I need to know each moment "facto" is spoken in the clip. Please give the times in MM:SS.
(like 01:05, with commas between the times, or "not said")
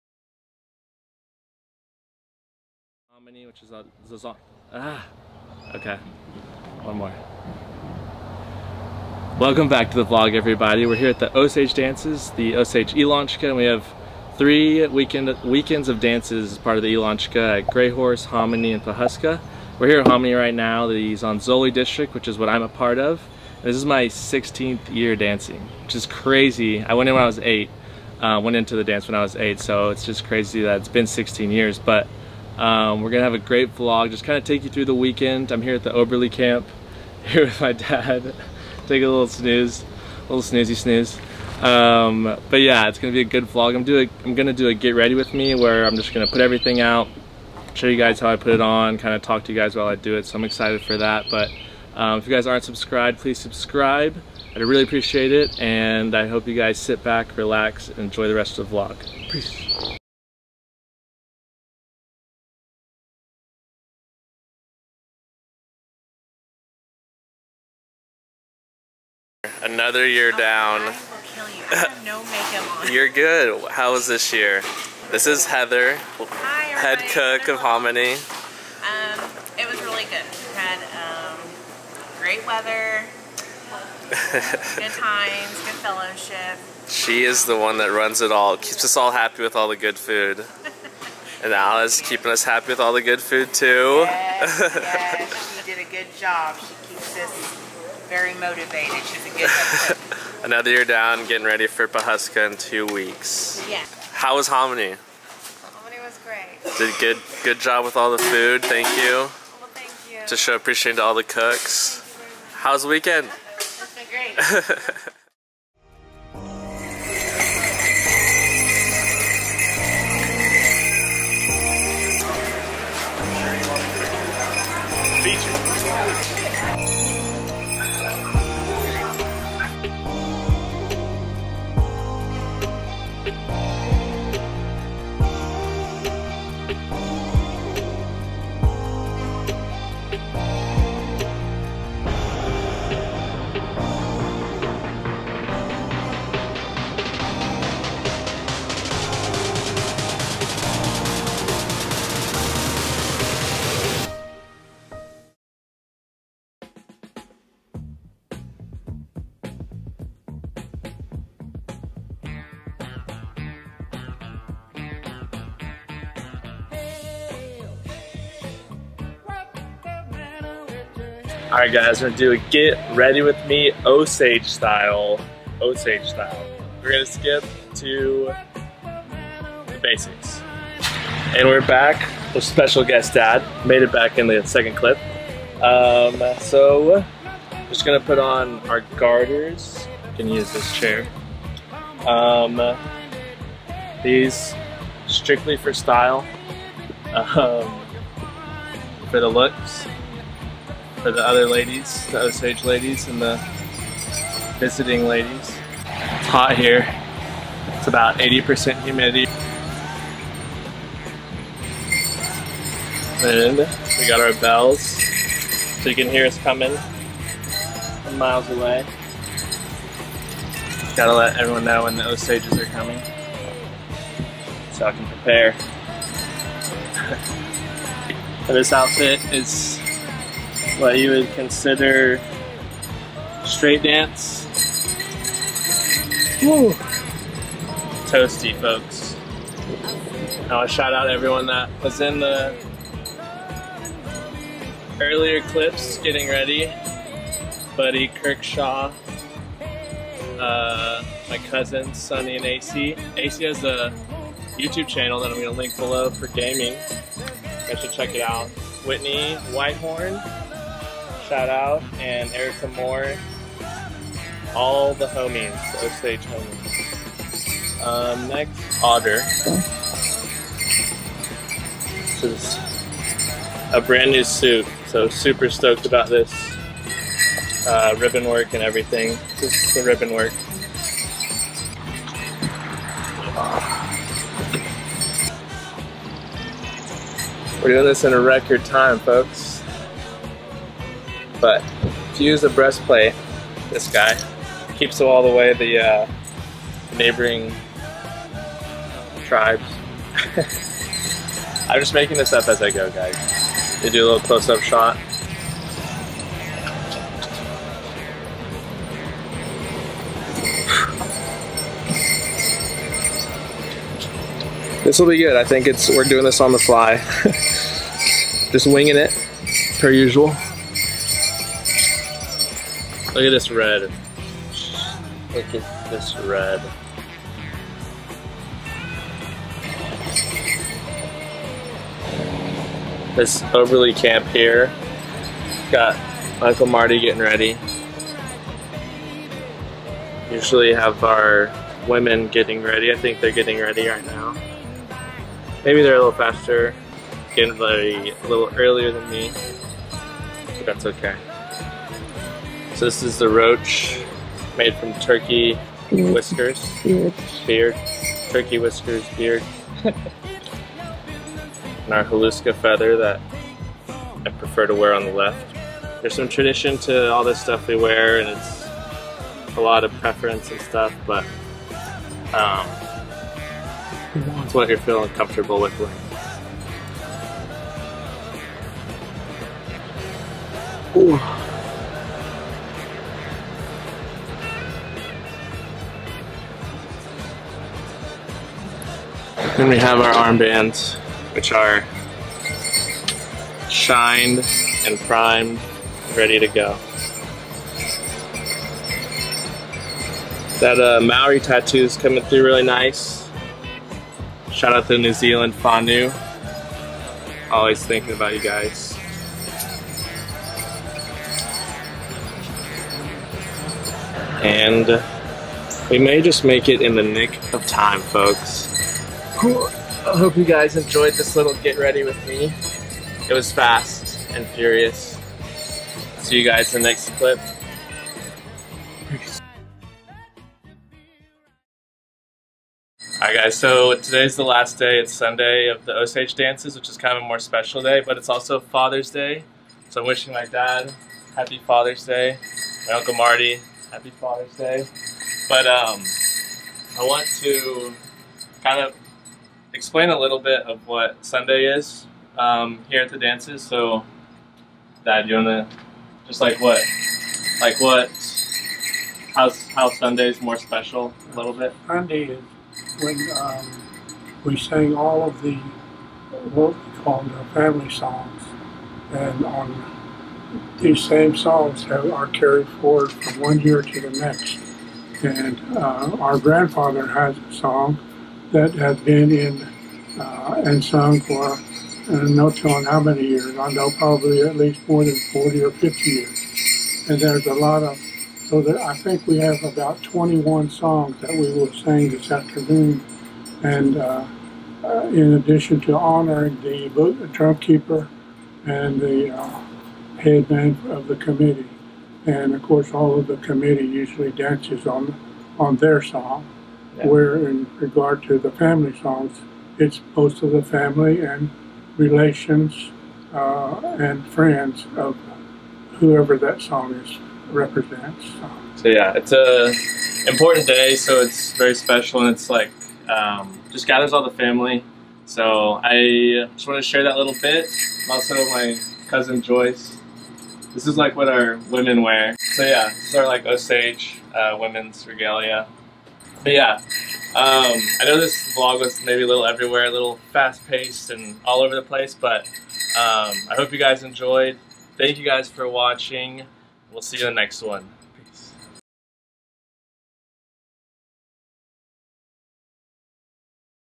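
not said.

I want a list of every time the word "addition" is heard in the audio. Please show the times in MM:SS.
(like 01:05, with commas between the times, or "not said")
08:15.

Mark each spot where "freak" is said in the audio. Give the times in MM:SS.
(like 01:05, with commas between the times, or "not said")
not said.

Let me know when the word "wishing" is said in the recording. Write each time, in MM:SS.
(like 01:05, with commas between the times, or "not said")
07:20.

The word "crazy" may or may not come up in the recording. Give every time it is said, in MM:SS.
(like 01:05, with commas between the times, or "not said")
00:26, 00:30.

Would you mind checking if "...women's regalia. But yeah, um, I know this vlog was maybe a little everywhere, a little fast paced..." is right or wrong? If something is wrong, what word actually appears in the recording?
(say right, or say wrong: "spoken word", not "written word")
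right.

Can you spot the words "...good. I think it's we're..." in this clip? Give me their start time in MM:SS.
05:15.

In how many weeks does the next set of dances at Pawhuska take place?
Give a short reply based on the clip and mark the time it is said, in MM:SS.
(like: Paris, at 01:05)
2, at 01:42.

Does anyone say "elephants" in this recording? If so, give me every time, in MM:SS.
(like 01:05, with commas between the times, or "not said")
not said.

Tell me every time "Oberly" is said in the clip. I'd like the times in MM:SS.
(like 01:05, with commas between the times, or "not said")
00:35, 05:33.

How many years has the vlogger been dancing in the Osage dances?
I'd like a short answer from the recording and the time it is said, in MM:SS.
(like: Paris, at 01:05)
16, at 00:24.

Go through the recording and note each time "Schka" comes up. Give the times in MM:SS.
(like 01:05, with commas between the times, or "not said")
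00:12, 00:16.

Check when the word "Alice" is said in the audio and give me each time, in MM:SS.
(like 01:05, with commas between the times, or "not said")
01:31.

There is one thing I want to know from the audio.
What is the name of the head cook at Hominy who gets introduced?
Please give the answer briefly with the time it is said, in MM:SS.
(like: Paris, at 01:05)
Heather, at 01:15.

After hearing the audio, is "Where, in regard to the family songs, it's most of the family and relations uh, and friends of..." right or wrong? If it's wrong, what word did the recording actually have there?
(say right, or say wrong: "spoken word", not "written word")
right.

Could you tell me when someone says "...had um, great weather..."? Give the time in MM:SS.
01:20.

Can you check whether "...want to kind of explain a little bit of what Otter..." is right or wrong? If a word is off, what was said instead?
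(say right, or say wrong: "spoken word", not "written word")
wrong: "Sunday", not "Otter".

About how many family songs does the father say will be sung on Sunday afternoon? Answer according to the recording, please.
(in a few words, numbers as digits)
21.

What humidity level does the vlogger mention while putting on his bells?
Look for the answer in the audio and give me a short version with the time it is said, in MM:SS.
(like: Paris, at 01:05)
80%, at 03:28.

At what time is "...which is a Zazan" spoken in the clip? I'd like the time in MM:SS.
00:03.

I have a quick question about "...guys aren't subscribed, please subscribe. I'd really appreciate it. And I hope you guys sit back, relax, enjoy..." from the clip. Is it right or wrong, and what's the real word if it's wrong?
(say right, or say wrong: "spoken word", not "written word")
right.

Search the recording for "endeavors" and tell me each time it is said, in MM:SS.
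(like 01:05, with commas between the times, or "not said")
not said.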